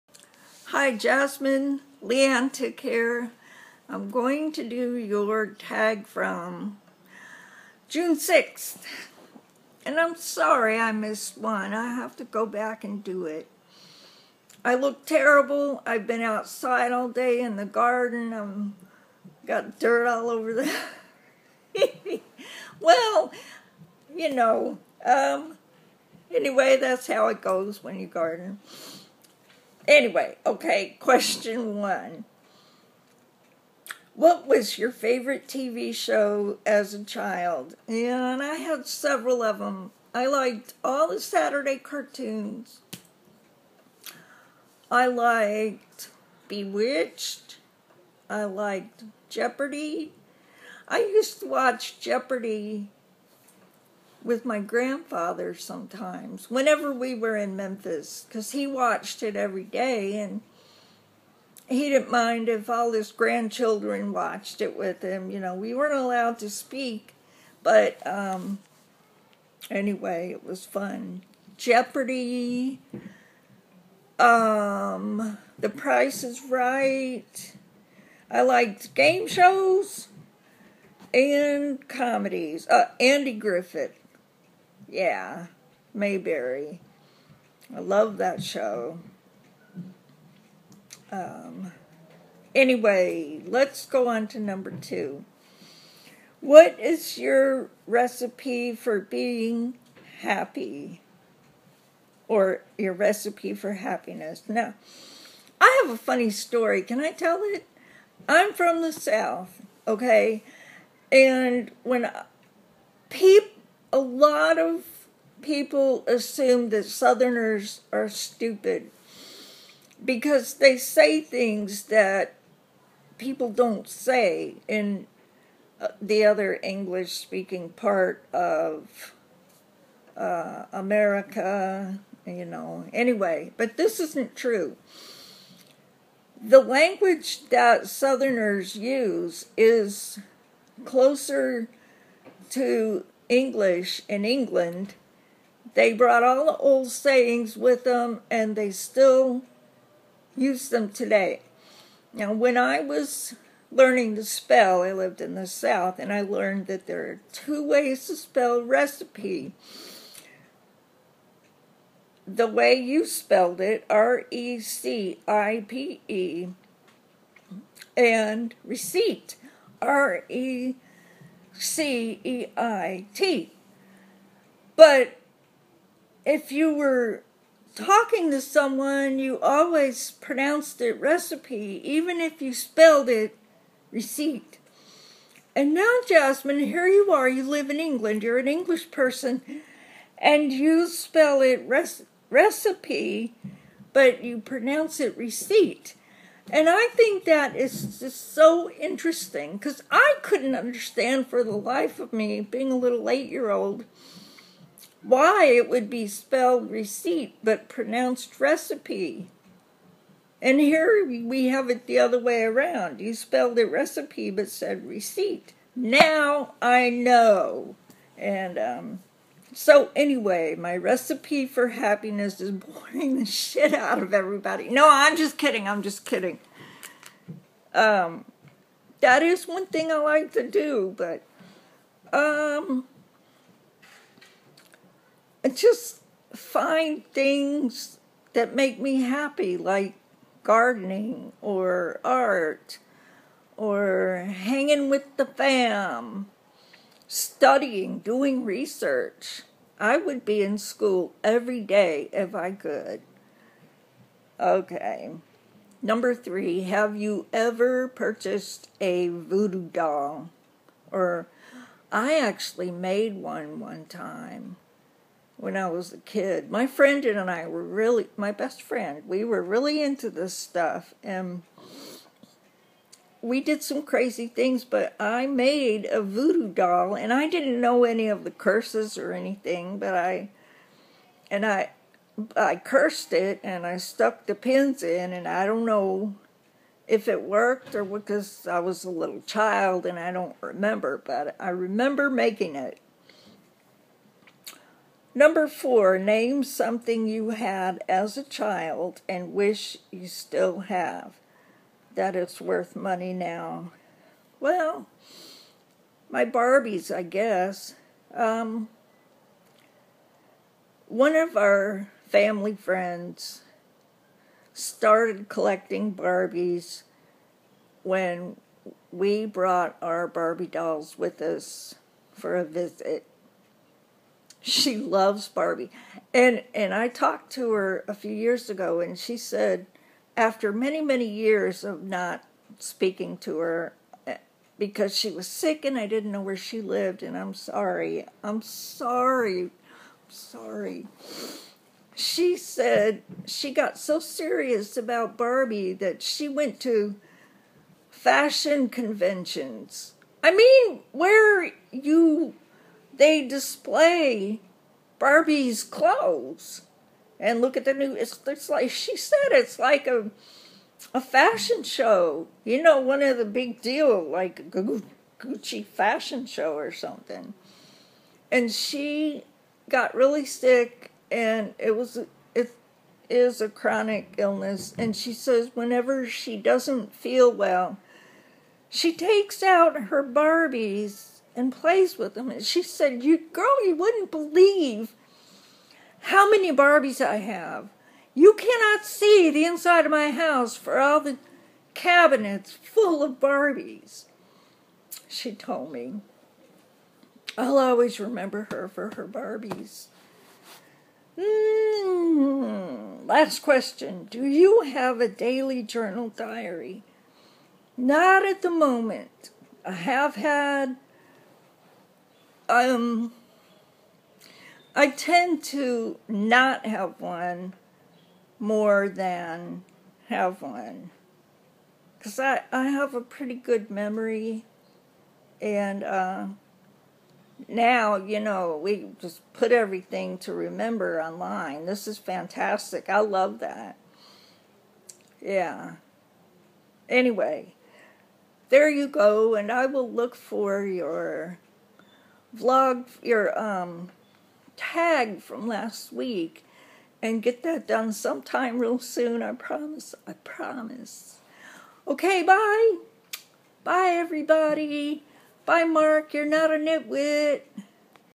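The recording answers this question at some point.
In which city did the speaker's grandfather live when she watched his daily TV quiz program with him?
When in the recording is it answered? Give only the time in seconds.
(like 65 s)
57 s.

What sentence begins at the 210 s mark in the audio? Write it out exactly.
And here we have it the other way around.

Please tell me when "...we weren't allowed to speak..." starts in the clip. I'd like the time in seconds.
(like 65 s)
65 s.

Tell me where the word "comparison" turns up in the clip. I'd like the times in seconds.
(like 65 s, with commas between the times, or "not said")
not said.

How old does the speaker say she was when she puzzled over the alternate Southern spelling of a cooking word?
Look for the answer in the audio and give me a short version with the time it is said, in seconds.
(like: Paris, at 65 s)
8, at 203 s.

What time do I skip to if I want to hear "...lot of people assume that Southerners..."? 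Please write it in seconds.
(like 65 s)
113 s.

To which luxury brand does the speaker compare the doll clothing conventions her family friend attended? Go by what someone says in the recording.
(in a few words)
Gucci.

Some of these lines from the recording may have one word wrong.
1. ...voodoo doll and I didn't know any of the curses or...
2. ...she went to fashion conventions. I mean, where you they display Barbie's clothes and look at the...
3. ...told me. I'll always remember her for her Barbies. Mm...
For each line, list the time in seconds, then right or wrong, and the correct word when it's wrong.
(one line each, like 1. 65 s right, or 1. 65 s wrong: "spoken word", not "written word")
1. 276 s right
2. 346 s right
3. 395 s right.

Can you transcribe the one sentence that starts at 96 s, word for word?
What is your recipe for being happy?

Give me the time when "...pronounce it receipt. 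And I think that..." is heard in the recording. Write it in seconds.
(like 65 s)
194 s.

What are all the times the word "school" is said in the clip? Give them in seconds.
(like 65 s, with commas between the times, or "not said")
250 s.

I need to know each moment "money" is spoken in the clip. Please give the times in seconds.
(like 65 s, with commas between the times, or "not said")
302 s.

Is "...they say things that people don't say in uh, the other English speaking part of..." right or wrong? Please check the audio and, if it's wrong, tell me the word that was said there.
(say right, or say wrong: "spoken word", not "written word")
right.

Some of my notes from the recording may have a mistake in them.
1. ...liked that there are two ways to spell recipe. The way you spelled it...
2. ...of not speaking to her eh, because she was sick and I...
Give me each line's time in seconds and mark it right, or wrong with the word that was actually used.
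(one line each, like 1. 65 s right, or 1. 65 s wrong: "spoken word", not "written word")
1. 156 s wrong: "learned", not "liked"
2. 331 s right.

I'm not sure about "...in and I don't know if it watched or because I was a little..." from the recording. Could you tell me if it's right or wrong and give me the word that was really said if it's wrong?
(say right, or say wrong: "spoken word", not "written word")
wrong: "worked", not "watched".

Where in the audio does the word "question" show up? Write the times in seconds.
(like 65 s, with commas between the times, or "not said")
30 s, 403 s.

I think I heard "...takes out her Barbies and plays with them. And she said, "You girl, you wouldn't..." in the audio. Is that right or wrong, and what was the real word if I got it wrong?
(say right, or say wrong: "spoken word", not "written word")
right.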